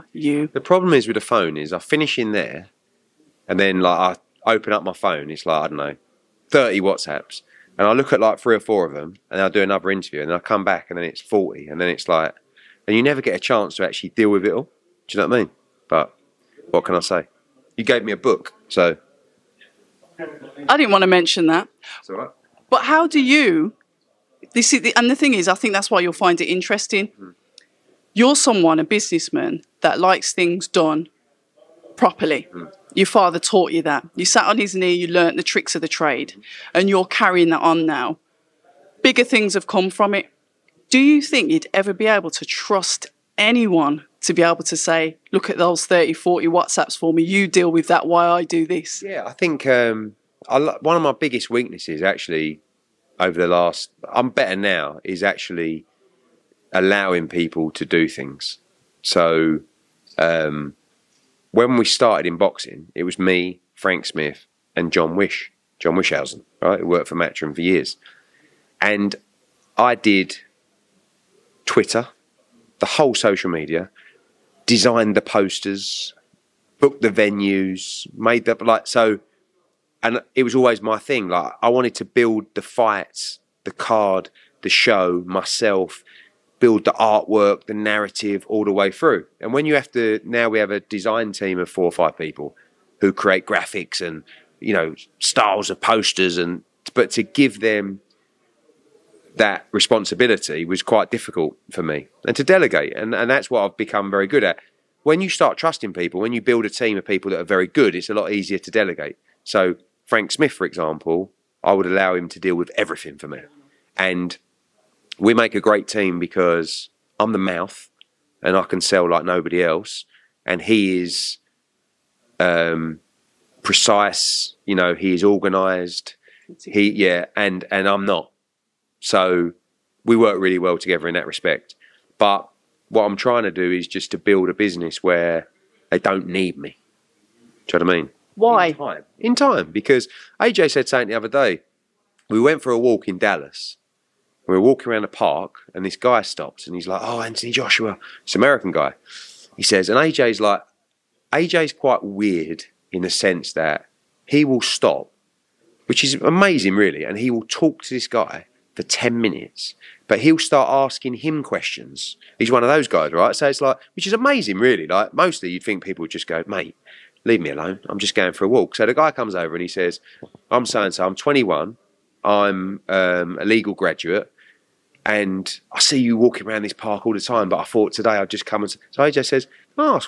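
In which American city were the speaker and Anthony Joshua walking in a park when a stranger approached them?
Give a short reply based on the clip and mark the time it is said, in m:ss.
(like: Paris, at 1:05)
Dallas, at 2:23.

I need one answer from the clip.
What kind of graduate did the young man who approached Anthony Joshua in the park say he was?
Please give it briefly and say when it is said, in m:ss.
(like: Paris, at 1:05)
Legal graduate, at 2:53.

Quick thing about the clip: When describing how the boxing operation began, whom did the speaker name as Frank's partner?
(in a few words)
John Wischhusen.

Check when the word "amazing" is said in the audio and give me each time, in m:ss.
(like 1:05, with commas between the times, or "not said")
2:36, 2:44.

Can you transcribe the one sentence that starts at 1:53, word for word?
And we make a great team because I'm the mouth and I can sell like nobody else.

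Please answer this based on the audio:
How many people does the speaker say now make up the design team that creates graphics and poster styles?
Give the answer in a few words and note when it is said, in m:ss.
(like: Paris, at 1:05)
4 or 5, at 1:31.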